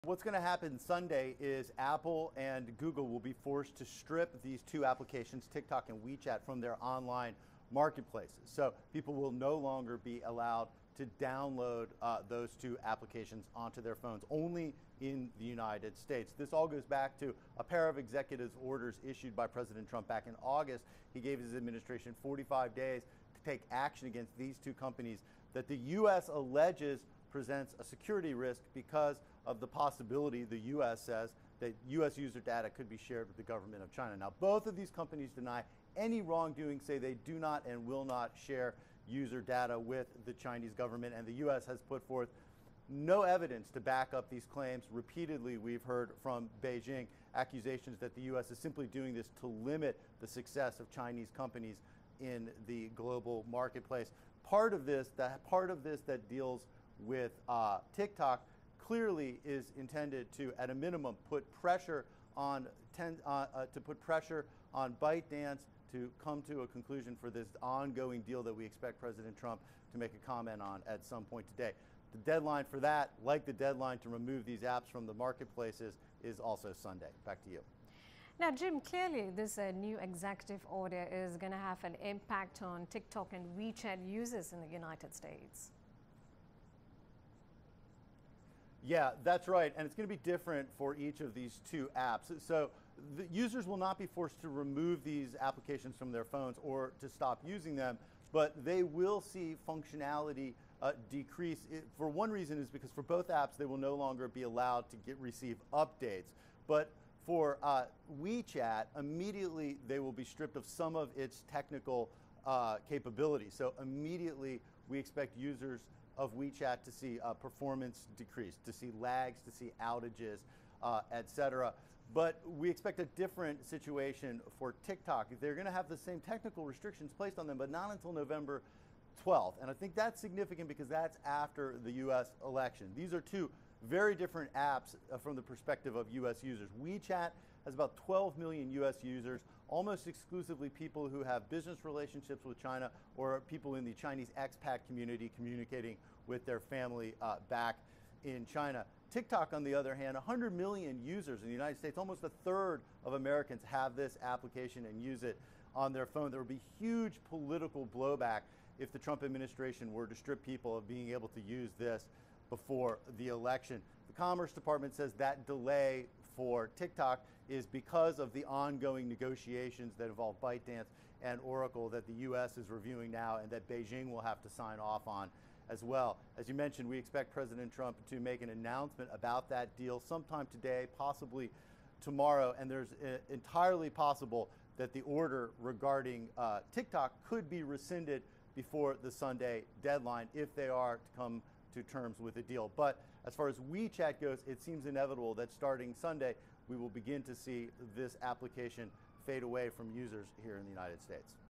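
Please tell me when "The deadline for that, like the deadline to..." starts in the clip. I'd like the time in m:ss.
1:12.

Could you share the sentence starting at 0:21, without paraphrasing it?
He gave his administration 45 days to take action against these two companies that the U.S.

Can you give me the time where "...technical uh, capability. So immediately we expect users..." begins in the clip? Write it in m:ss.
1:51.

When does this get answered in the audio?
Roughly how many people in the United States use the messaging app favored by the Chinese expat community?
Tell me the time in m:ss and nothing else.
2:18.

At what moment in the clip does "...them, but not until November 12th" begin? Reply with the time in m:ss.
2:07.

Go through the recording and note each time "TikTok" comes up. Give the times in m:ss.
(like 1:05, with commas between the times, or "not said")
0:05, 0:57, 1:22, 2:04, 2:29, 2:46, 3:06.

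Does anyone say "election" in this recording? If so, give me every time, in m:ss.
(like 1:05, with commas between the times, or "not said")
2:12, 2:43.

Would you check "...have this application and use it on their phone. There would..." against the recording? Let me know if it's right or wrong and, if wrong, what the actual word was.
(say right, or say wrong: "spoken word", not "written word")
right.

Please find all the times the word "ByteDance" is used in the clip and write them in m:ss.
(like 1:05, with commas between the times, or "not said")
1:05, 2:50.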